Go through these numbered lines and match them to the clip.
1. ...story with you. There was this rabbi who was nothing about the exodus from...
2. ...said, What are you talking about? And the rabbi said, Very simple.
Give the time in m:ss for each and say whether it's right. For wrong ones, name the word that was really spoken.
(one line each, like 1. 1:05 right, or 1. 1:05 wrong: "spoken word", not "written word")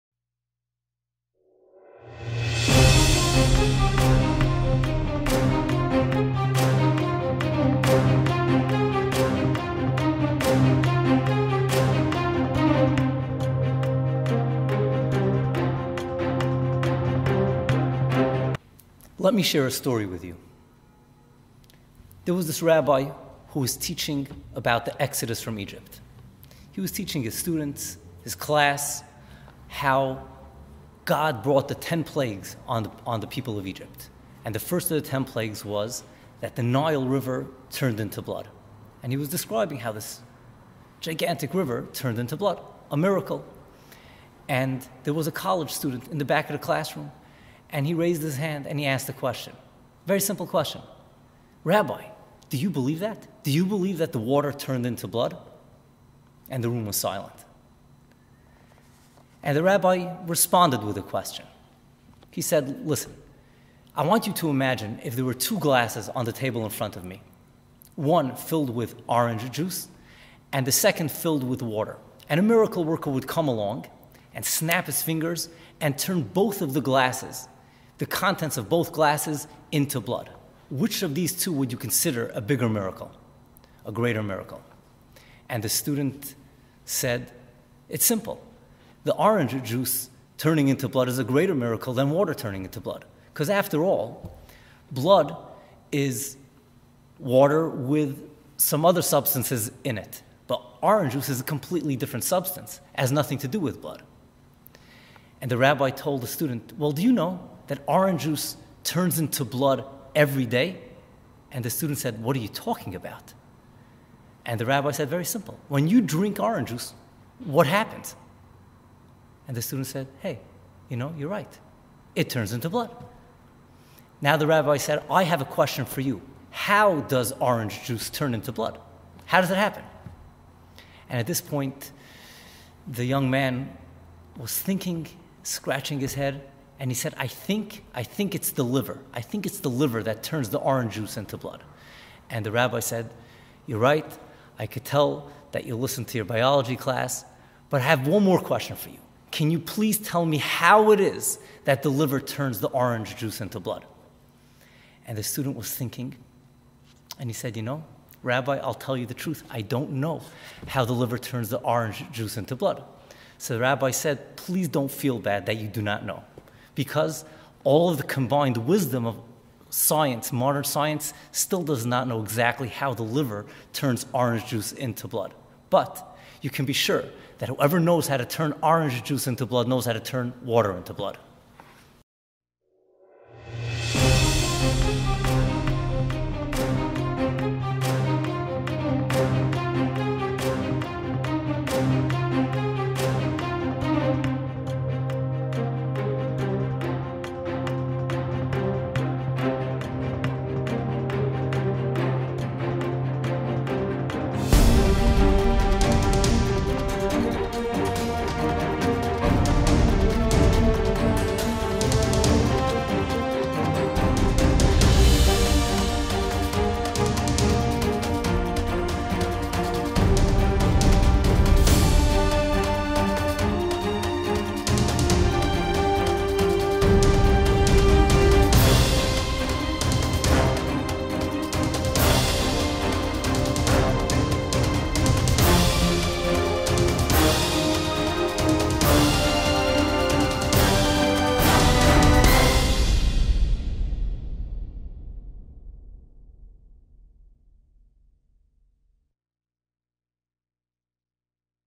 1. 0:19 wrong: "teaching", not "nothing"
2. 1:51 right.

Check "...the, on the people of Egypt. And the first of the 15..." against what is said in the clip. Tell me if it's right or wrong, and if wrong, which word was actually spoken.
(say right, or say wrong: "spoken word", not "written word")
wrong: "10", not "15".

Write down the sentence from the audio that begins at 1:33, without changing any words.
Because after all, blood is water with some other substances in it.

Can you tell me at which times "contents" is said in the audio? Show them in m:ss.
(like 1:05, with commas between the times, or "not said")
1:18.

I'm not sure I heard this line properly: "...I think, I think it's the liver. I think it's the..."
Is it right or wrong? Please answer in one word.
right.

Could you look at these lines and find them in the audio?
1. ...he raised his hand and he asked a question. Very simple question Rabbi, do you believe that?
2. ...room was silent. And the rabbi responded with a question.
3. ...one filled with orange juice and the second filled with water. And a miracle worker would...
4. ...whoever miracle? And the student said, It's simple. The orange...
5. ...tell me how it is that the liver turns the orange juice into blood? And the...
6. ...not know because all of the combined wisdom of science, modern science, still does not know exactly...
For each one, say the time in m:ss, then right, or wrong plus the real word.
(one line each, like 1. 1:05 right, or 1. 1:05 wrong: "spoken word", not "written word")
1. 0:47 right
2. 0:56 right
3. 1:07 right
4. 1:23 wrong: "greater", not "whoever"
5. 2:29 right
6. 2:45 right.